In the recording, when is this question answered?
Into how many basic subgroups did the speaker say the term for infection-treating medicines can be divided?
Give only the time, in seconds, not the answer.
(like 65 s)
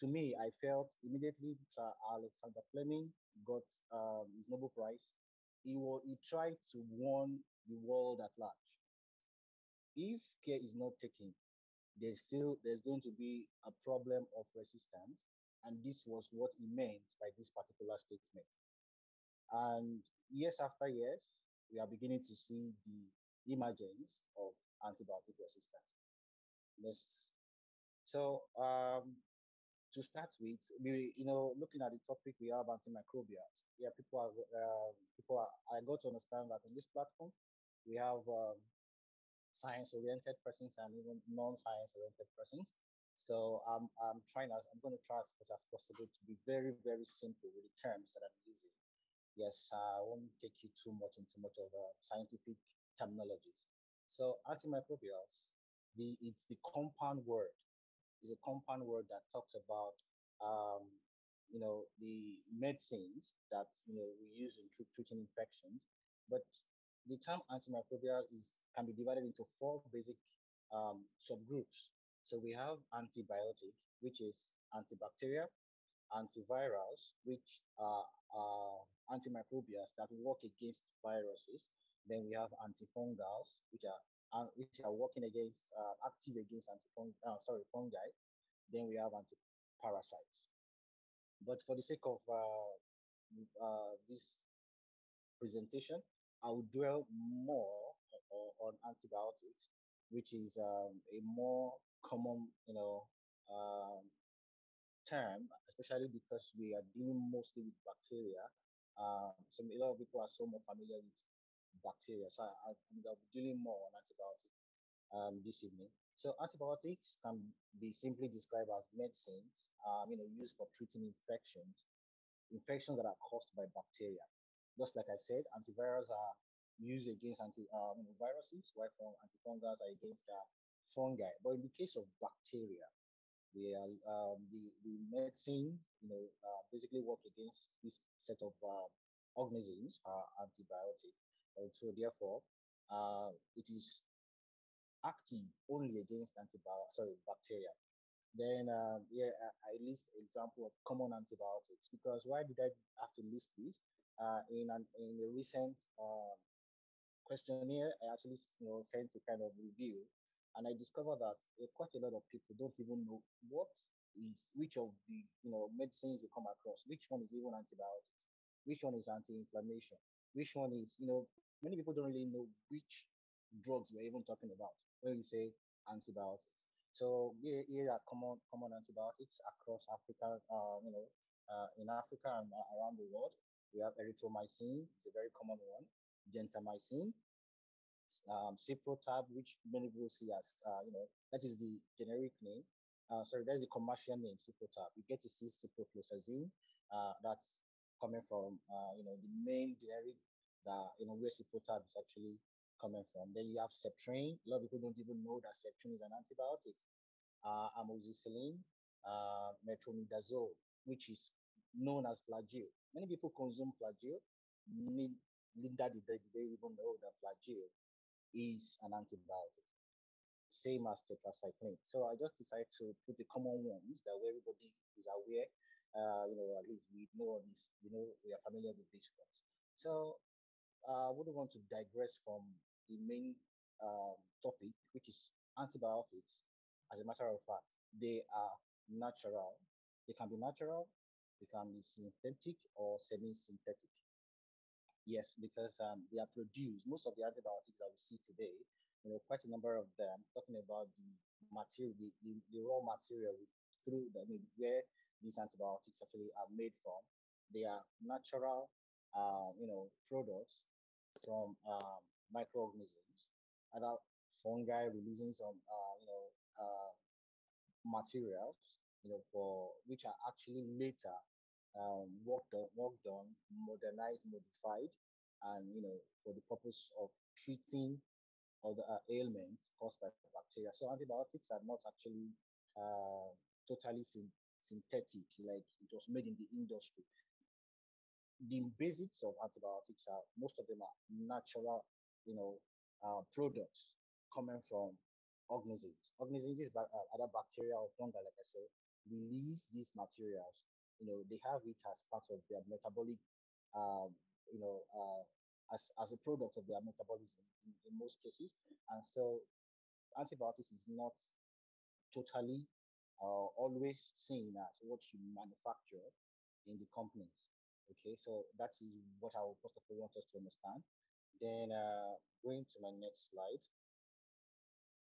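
69 s.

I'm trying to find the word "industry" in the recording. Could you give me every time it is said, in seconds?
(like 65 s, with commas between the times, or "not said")
286 s.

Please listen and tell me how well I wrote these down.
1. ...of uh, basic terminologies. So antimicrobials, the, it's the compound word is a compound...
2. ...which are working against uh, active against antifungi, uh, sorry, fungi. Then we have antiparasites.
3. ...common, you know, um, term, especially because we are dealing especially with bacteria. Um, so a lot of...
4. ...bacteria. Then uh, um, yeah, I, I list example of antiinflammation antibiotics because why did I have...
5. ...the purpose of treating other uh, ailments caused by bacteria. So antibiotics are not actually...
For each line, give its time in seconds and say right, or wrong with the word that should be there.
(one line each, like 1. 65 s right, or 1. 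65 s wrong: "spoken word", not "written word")
1. 51 s wrong: "scientific", not "basic"
2. 84 s right
3. 102 s wrong: "mostly", not "especially"
4. 147 s wrong: "common", not "antiinflammation"
5. 276 s right.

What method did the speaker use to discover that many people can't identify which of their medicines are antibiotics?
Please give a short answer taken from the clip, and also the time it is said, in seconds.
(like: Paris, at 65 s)
Questionnaire, at 157 s.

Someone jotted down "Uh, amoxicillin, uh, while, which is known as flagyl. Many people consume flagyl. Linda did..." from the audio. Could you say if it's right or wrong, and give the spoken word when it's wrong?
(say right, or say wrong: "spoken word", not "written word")
wrong: "metronidazole", not "while".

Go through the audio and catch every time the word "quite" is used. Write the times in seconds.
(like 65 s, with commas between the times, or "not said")
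161 s, 249 s.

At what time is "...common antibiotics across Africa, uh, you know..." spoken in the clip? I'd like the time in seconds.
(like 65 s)
178 s.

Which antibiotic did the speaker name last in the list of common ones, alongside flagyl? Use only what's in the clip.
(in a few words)
Tetracycline.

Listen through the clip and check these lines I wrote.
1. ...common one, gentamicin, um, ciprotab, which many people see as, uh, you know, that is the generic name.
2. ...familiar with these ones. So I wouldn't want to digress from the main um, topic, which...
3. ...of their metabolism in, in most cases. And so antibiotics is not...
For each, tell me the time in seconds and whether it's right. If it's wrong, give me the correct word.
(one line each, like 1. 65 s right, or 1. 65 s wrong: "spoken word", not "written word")
1. 185 s right
2. 228 s right
3. 306 s right.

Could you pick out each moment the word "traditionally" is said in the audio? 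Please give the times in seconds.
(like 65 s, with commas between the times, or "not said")
not said.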